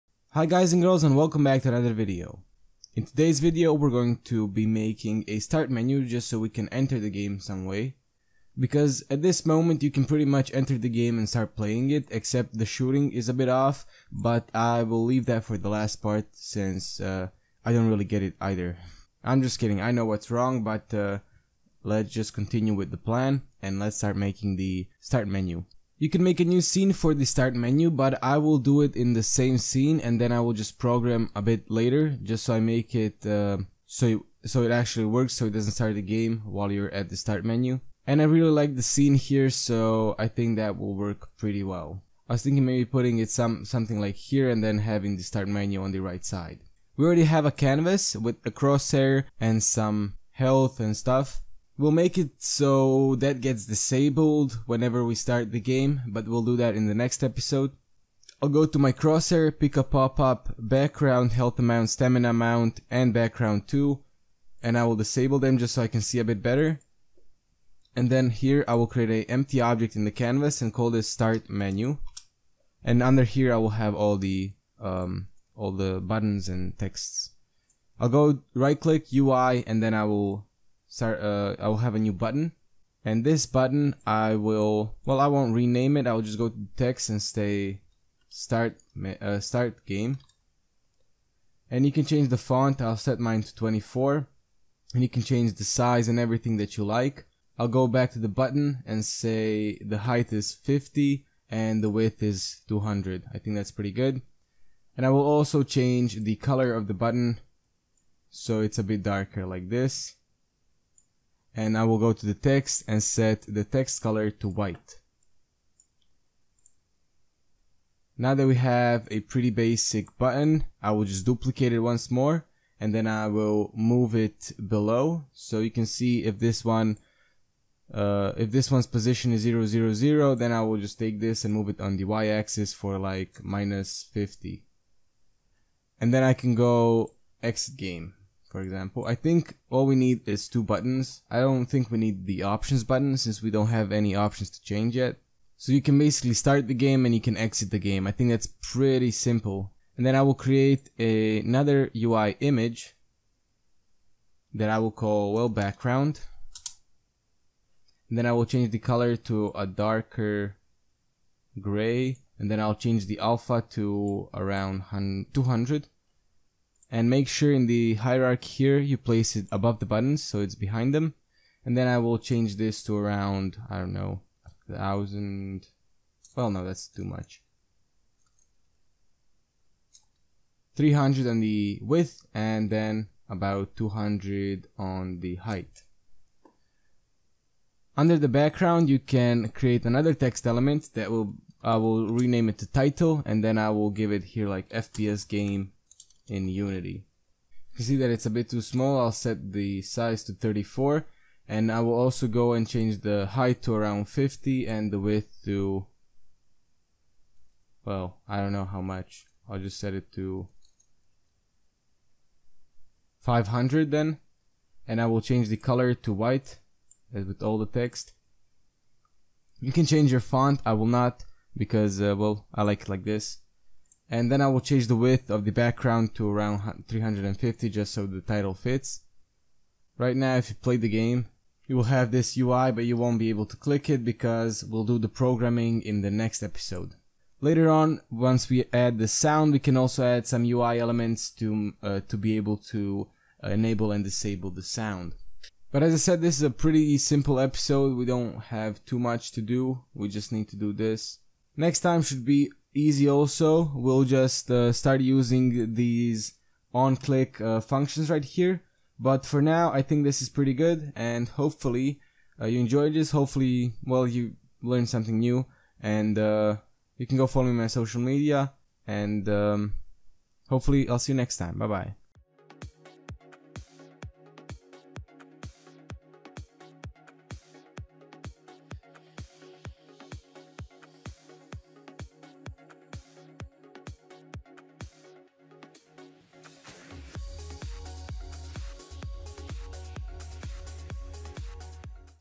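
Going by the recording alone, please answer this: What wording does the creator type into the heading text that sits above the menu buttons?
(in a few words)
FPS game in Unity.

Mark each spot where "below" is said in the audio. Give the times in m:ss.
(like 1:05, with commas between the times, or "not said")
2:04.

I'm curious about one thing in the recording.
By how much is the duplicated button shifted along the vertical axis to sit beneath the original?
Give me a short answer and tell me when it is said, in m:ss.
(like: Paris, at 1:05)
-50, at 2:13.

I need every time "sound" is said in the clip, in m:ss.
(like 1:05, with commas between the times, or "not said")
3:59, 4:04.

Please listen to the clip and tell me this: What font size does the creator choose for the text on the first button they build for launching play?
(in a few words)
24.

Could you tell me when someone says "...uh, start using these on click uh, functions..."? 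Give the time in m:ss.
4:14.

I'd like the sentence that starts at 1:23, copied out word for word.
And this button, I will, well, I won't rename it.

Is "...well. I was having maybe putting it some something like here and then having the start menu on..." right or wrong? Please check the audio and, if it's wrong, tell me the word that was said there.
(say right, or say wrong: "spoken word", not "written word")
wrong: "thinking", not "having".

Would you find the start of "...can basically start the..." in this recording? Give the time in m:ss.
2:25.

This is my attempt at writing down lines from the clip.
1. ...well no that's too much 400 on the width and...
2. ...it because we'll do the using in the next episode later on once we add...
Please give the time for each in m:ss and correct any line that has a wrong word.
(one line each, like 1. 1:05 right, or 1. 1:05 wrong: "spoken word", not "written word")
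1. 2:56 wrong: "300", not "400"
2. 3:53 wrong: "programming", not "using".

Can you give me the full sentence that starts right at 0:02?
In today's video we're going to be making a start menu just so we can enter the game some way.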